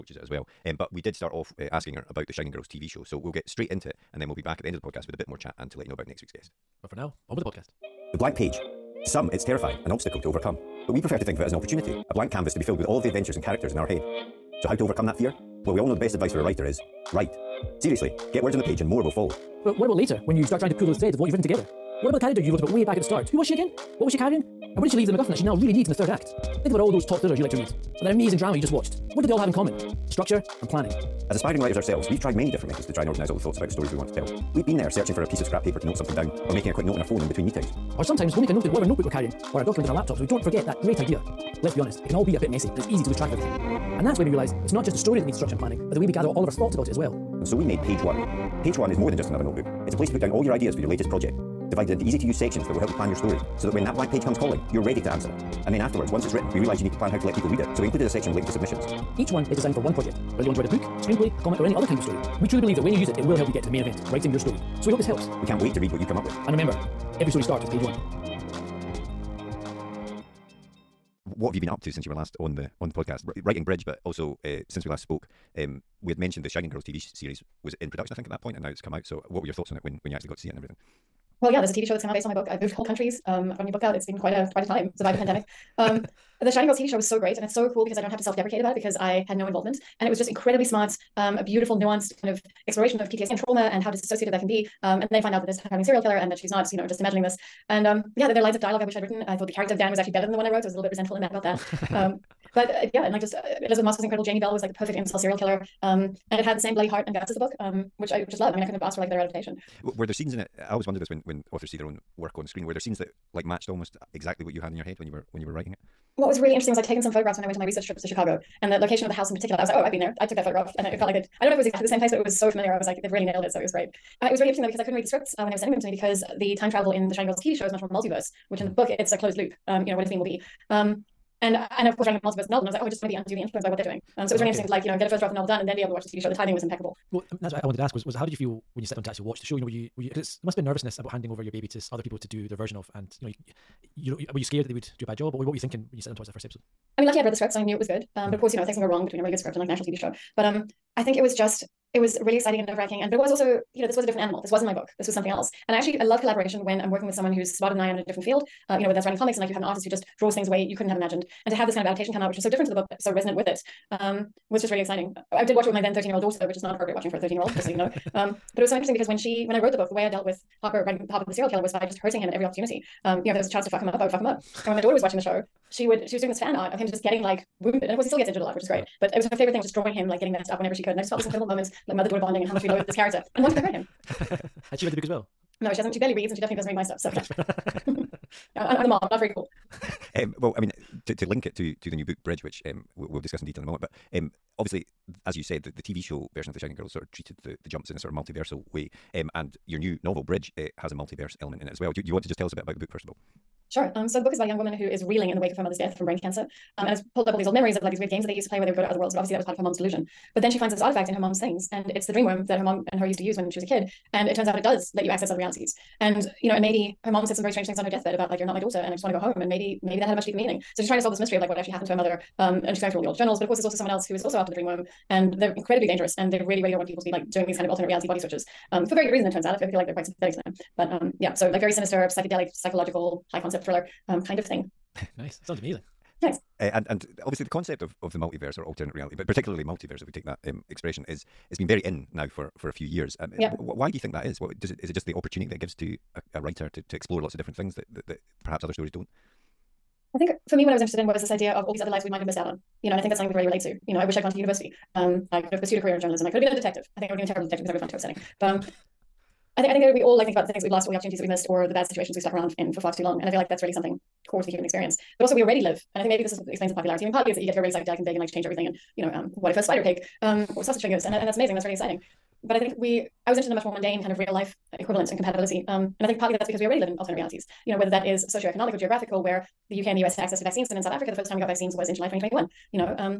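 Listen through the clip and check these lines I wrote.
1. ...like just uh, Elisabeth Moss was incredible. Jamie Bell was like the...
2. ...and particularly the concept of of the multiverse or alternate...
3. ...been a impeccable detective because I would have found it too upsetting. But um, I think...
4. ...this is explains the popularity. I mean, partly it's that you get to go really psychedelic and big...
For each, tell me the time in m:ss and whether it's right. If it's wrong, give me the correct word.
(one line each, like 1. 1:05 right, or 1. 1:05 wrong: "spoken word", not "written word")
1. 1:43 right
2. 3:56 wrong: "obviously", not "particularly"
3. 4:17 wrong: "terrible", not "impeccable"
4. 4:26 right.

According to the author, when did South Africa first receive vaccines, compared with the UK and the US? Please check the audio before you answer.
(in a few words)
July 2021.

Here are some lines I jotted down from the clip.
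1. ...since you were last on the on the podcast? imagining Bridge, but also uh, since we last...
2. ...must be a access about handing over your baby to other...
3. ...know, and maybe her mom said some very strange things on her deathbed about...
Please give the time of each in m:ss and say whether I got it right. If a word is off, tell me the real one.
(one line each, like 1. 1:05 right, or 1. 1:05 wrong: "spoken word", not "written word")
1. 1:11 wrong: "writing", not "imagining"
2. 2:20 wrong: "nervousness", not "access"
3. 3:36 right.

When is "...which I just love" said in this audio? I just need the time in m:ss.
1:47.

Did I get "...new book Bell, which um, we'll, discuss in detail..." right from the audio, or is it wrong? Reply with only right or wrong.
wrong.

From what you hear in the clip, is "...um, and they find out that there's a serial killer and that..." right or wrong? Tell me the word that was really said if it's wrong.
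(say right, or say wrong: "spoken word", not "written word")
right.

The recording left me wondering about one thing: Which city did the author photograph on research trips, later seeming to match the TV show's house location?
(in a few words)
Chicago.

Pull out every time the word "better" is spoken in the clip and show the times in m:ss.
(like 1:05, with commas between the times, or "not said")
1:40, 1:49.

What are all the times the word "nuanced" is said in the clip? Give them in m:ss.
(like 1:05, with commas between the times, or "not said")
1:31.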